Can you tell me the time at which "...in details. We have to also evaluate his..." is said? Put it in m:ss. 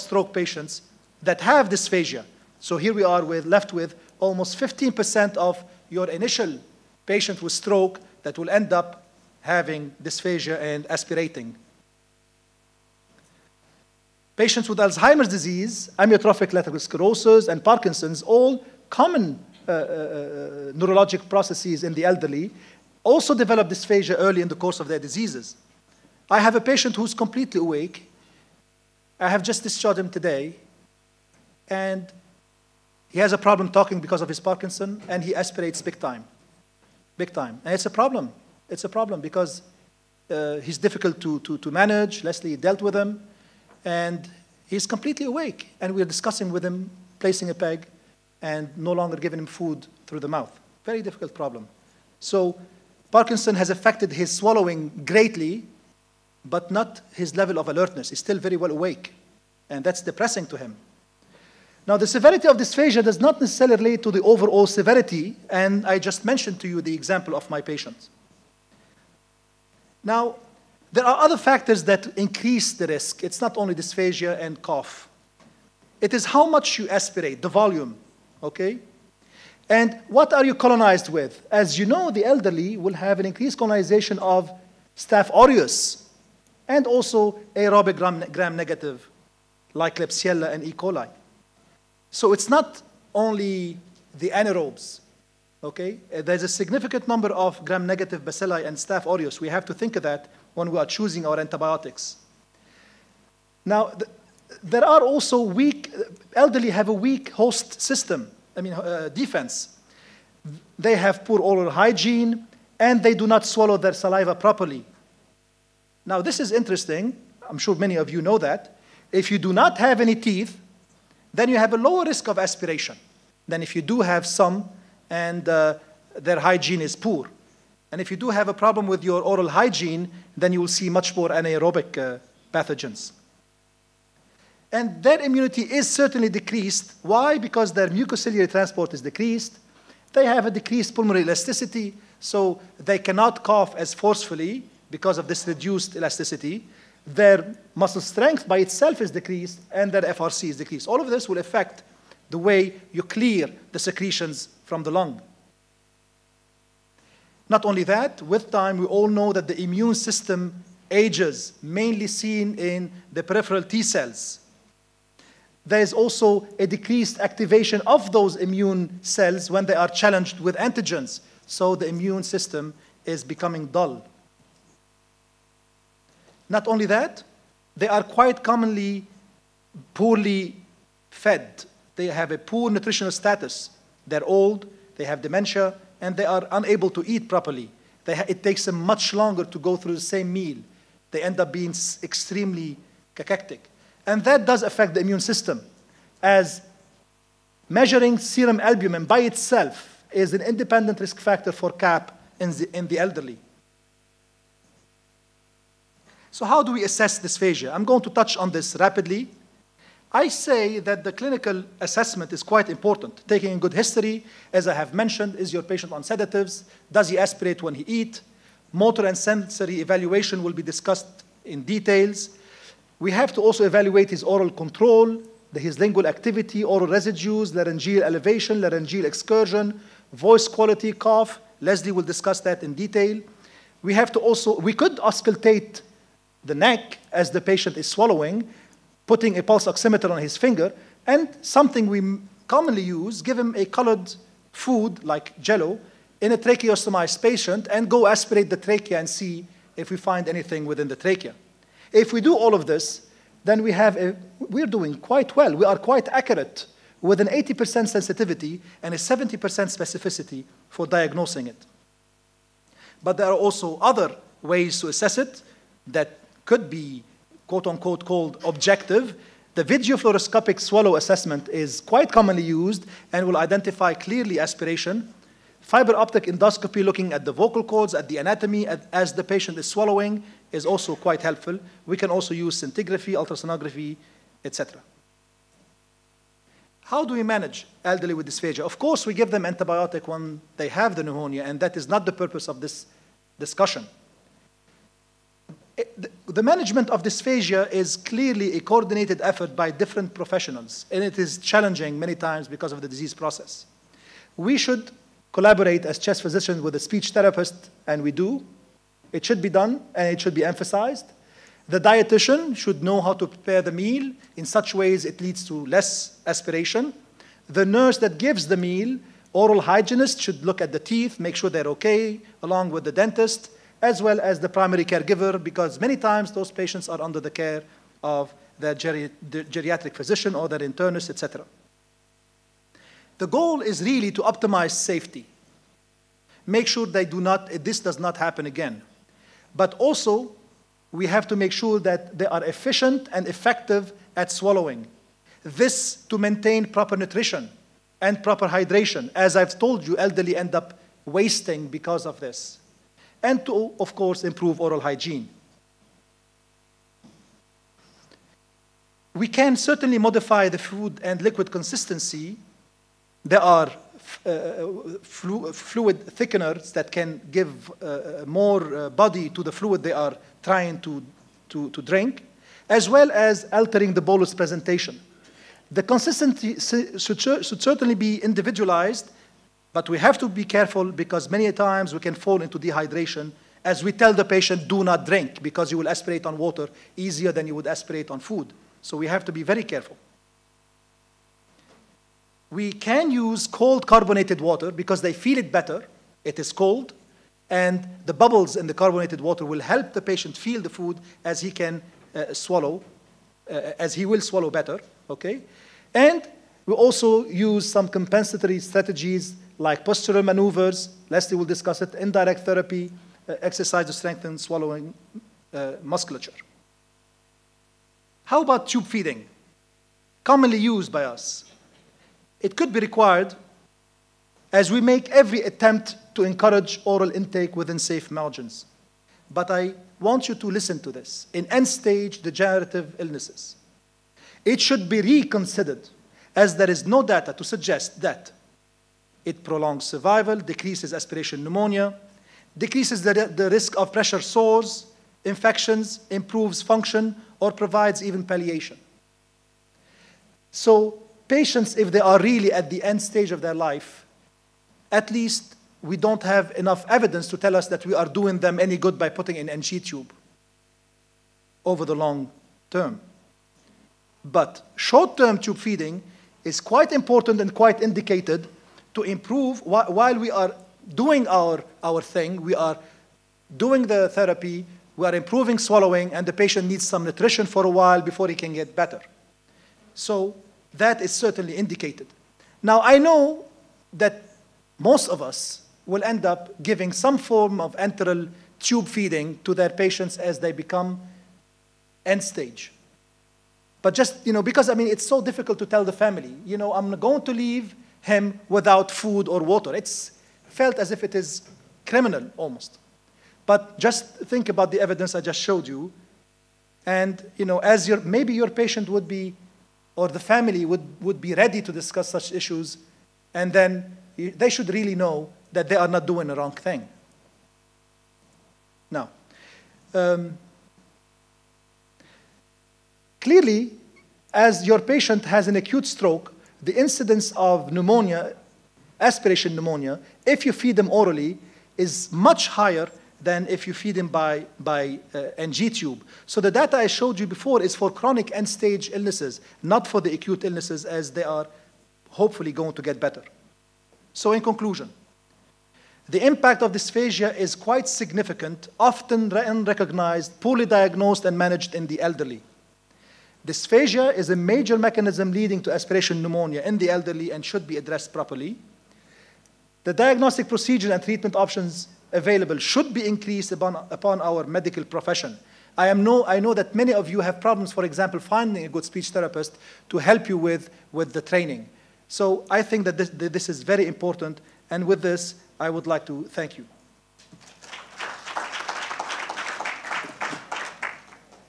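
3:41.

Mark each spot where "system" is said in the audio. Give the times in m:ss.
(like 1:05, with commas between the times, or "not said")
1:47, 2:39, 2:52, 3:15.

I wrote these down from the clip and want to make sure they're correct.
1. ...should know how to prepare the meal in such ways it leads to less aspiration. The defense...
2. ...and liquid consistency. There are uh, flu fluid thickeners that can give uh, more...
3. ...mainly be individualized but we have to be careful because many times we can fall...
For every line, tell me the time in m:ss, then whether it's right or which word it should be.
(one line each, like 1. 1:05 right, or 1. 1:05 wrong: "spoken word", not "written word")
1. 5:12 wrong: "nurse", not "defense"
2. 6:01 right
3. 6:17 wrong: "certainly", not "mainly".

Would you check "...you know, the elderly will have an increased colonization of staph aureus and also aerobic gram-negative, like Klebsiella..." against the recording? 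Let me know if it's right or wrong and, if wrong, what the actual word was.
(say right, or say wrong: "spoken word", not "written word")
right.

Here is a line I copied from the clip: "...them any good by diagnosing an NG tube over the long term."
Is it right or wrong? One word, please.
wrong.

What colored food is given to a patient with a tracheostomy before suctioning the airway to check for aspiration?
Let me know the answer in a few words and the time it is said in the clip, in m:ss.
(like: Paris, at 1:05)
Jello, at 4:05.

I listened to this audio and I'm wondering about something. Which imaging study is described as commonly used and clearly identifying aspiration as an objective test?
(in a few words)
Video fluoroscopic swallow assessment.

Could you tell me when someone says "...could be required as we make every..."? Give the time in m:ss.
7:02.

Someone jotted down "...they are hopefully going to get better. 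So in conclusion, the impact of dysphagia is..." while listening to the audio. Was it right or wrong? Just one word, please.
right.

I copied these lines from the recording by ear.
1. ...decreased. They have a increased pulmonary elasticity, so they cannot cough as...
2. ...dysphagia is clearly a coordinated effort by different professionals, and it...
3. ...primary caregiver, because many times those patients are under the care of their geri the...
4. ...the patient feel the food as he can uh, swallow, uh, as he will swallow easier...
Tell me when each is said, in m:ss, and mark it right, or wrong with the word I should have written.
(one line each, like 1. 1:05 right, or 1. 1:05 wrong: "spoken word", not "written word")
1. 2:19 wrong: "decreased", not "increased"
2. 4:57 right
3. 5:24 right
4. 6:39 wrong: "better", not "easier".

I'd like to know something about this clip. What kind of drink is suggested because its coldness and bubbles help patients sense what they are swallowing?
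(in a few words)
Cold carbonated water.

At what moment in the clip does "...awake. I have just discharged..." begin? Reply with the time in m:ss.
0:27.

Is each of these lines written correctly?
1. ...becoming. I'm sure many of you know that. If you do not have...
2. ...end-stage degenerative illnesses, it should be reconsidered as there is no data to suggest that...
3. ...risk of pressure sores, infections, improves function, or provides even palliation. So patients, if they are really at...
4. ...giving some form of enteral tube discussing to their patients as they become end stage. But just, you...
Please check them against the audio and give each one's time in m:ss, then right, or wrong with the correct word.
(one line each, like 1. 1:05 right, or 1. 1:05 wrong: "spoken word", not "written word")
1. 1:56 wrong: "interesting", not "becoming"
2. 7:11 right
3. 7:23 right
4. 8:06 wrong: "feeding", not "discussing".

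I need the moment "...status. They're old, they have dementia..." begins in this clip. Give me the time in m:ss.
3:03.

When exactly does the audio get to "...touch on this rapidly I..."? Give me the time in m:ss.
3:28.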